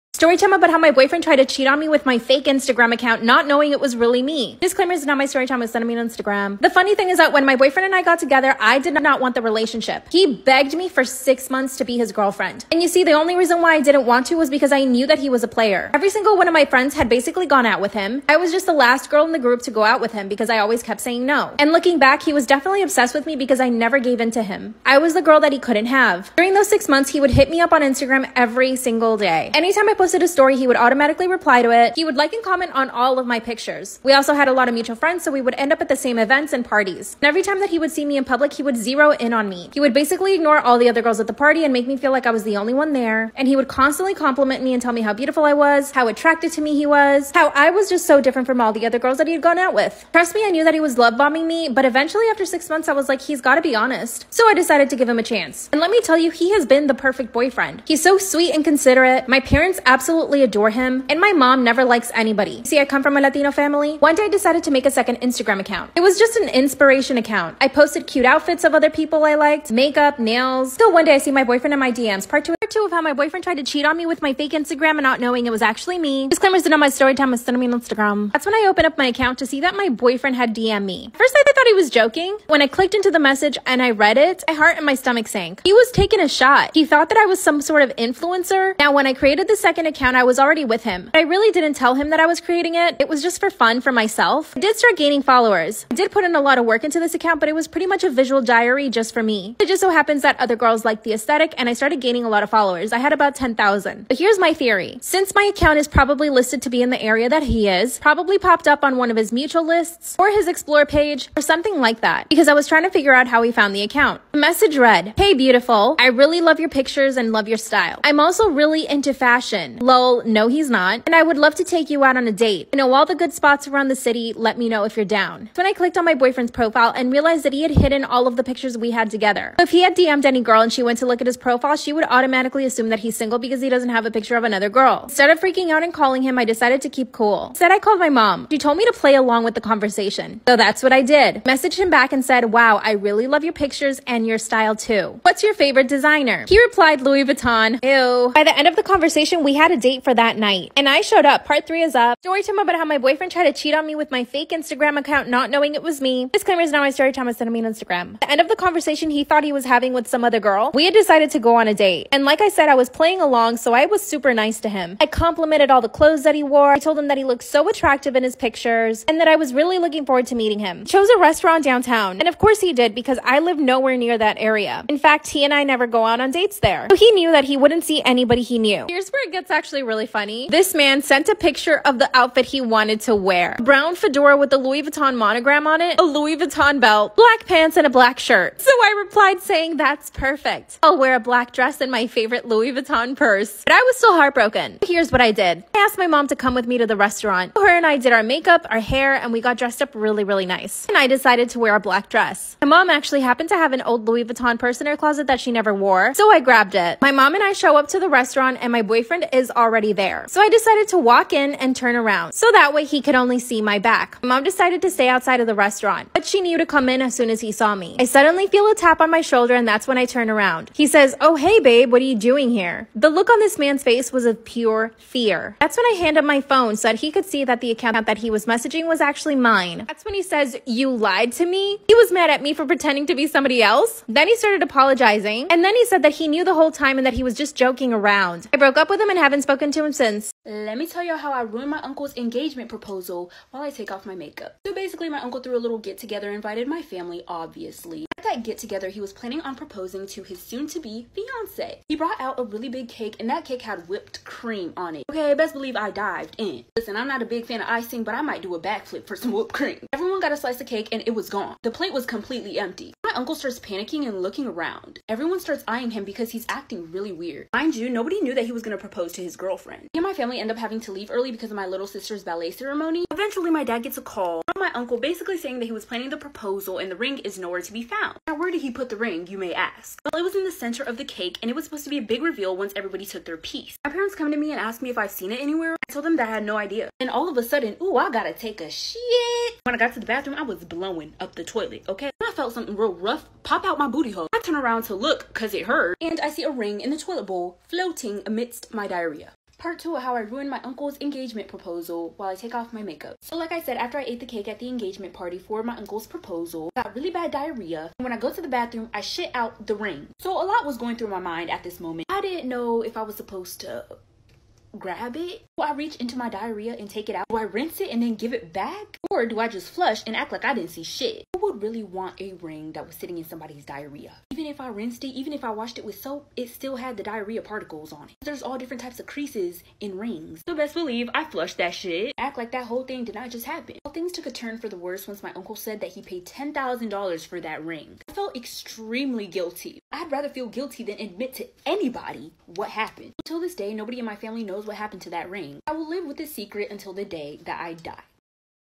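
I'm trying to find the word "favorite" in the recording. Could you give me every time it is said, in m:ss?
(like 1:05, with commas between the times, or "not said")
2:25, 3:12.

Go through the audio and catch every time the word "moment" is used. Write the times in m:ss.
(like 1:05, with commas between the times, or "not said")
5:11.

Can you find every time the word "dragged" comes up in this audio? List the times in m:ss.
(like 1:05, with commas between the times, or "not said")
not said.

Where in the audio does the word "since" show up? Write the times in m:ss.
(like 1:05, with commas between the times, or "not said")
1:45, 3:59.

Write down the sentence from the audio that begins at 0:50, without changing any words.
Trust me, I knew that he was love bombing me, but eventually after six months, I was like, he's gotta be honest.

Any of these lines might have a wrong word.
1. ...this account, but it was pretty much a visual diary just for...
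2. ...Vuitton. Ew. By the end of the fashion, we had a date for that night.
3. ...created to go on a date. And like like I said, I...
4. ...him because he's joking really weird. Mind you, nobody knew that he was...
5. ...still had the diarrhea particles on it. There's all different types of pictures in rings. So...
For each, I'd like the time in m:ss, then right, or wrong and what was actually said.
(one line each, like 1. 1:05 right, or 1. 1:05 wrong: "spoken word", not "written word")
1. 1:37 right
2. 2:27 wrong: "conversation", not "fashion"
3. 2:40 wrong: "decided", not "created"
4. 4:25 wrong: "acting", not "joking"
5. 5:26 wrong: "creases", not "pictures".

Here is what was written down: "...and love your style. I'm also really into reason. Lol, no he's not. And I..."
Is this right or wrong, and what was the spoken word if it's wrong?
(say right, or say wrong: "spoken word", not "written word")
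wrong: "fashion", not "reason".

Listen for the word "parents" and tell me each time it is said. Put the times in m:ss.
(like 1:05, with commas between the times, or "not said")
0:59, 4:43.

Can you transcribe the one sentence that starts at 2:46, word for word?
I told him that he looked so attractive in his pictures and that I was really looking forward to meeting him.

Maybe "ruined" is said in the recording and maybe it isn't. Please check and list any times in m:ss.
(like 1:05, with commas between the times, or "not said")
4:01, 5:00.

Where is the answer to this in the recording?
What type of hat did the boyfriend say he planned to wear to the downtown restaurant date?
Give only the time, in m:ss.
3:03.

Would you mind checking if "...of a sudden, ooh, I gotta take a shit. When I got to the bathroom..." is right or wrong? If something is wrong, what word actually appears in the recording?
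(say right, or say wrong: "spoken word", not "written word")
right.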